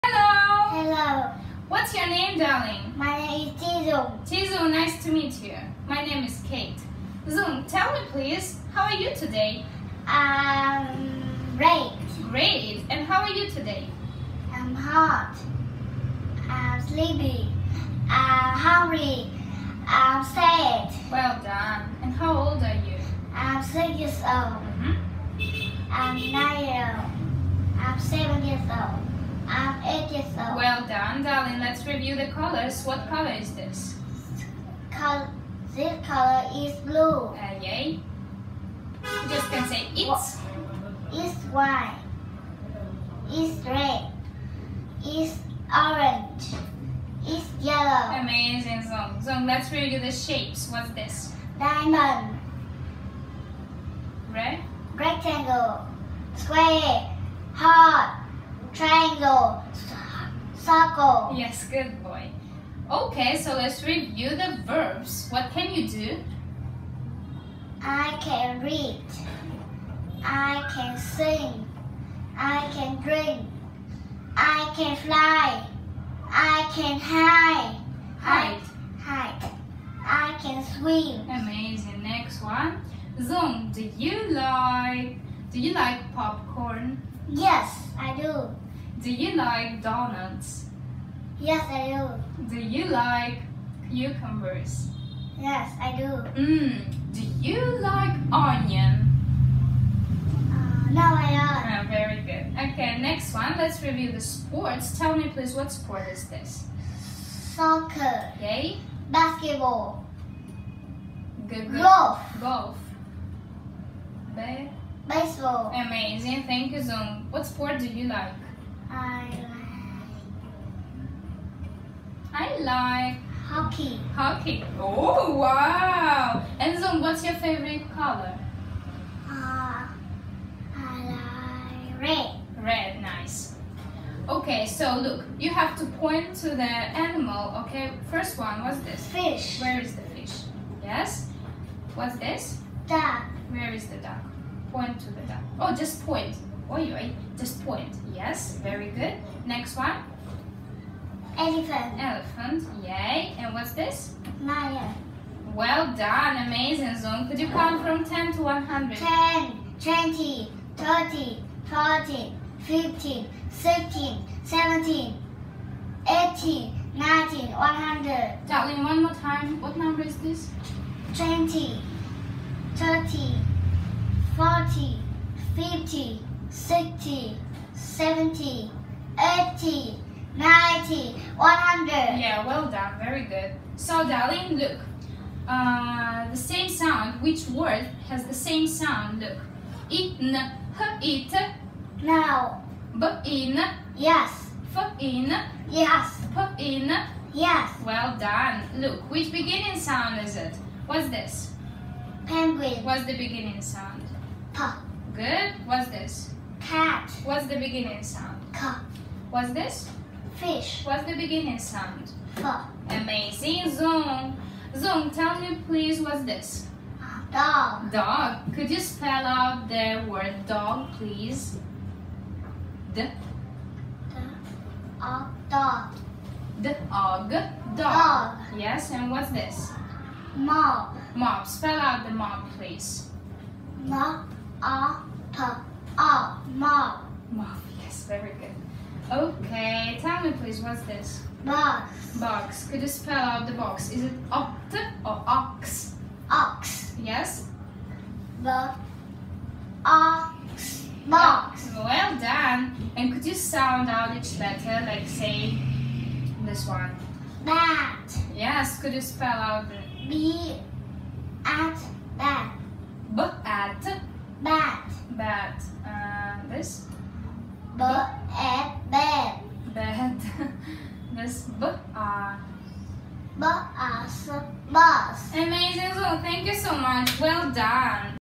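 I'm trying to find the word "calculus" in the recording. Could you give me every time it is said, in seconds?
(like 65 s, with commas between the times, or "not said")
not said.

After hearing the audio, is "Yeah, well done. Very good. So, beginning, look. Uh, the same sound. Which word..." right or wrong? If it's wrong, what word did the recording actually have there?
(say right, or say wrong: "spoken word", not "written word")
wrong: "darling", not "beginning".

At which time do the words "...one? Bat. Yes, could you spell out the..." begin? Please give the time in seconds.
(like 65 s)
256 s.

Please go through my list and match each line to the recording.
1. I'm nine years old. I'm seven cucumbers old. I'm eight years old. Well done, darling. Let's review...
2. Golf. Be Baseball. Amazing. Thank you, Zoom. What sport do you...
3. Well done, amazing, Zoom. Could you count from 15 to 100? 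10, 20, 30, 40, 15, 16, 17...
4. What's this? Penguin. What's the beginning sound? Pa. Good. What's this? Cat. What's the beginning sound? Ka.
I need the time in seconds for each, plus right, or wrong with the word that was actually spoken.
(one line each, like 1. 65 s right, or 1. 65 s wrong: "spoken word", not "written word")
1. 25 s wrong: "years", not "cucumbers"
2. 112 s right
3. 155 s wrong: "10", not "15"
4. 200 s right.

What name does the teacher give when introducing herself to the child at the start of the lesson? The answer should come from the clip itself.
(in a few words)
Kate.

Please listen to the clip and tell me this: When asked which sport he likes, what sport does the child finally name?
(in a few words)
Hockey.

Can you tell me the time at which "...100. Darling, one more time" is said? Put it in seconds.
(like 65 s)
167 s.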